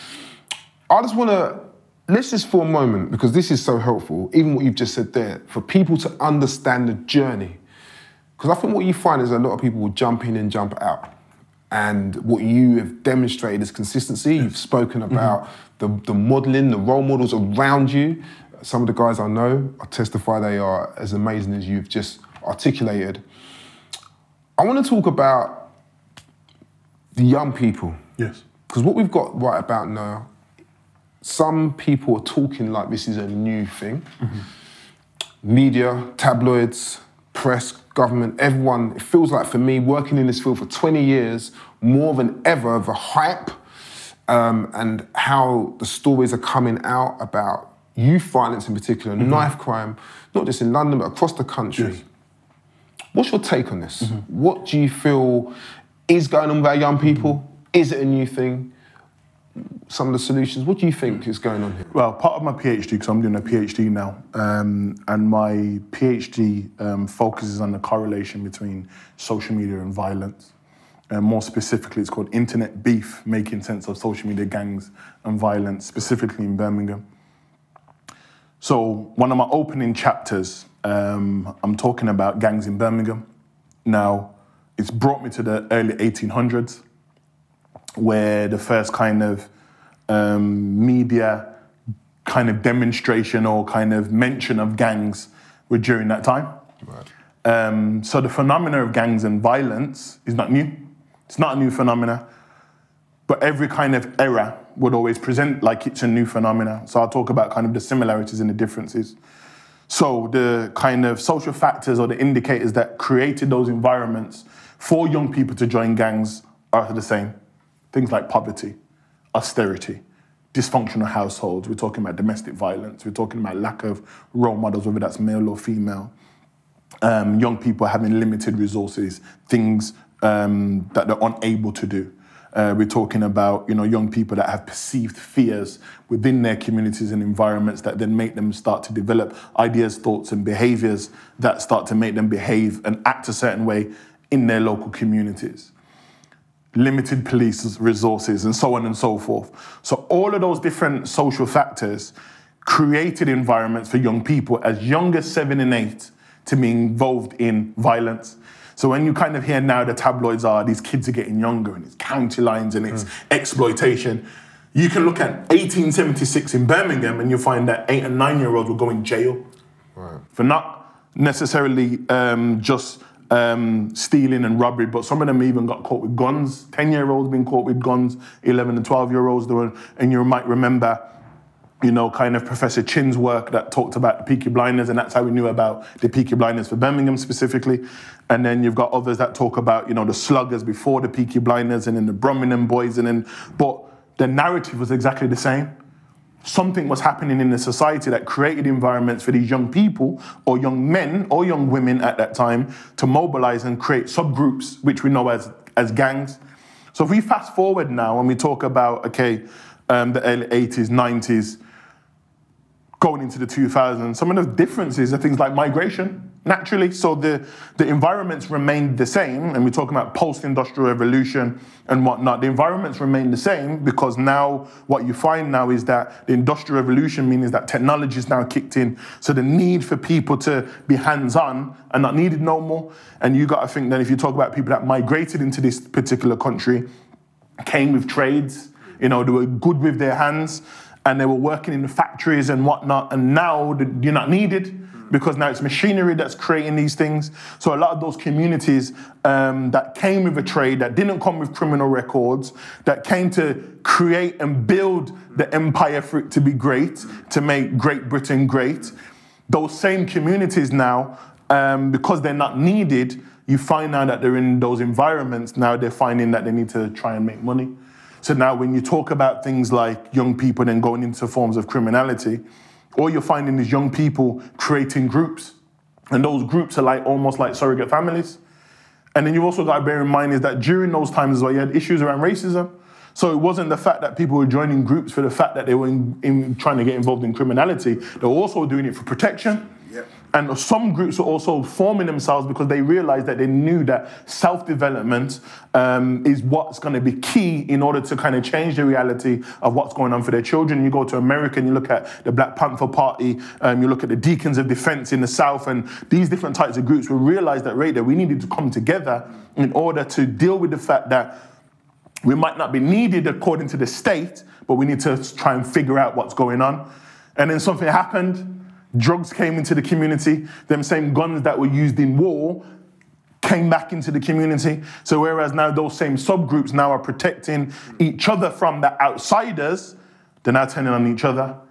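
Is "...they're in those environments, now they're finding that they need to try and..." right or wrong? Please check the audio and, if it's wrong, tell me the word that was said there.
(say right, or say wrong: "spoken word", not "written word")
right.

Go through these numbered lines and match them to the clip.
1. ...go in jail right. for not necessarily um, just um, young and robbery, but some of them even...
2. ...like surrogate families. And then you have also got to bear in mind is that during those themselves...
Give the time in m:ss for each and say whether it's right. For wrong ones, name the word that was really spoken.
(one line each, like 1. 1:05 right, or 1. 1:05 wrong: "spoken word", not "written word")
1. 2:48 wrong: "stealing", not "young"
2. 4:37 wrong: "times", not "themselves".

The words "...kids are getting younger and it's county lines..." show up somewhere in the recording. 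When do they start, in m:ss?
2:40.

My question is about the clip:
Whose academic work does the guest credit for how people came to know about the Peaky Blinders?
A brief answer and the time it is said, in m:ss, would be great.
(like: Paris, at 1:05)
Professor Chinn, at 3:02.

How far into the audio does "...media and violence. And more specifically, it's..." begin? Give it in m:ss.
1:09.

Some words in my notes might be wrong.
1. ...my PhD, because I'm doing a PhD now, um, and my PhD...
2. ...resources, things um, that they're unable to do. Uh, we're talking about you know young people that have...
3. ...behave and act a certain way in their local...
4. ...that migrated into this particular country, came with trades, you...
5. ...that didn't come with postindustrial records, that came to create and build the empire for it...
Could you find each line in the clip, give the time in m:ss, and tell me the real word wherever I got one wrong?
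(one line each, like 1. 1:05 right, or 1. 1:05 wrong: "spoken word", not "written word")
1. 1:02 right
2. 2:08 right
3. 2:22 right
4. 3:54 right
5. 4:10 wrong: "criminal", not "postindustrial".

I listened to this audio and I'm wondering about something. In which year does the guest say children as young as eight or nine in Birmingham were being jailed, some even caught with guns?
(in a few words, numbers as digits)
1876.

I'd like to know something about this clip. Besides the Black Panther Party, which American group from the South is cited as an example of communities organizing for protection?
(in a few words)
Deacons of Defense.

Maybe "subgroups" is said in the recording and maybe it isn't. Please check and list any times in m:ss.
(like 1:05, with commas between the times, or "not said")
3:24, 5:26.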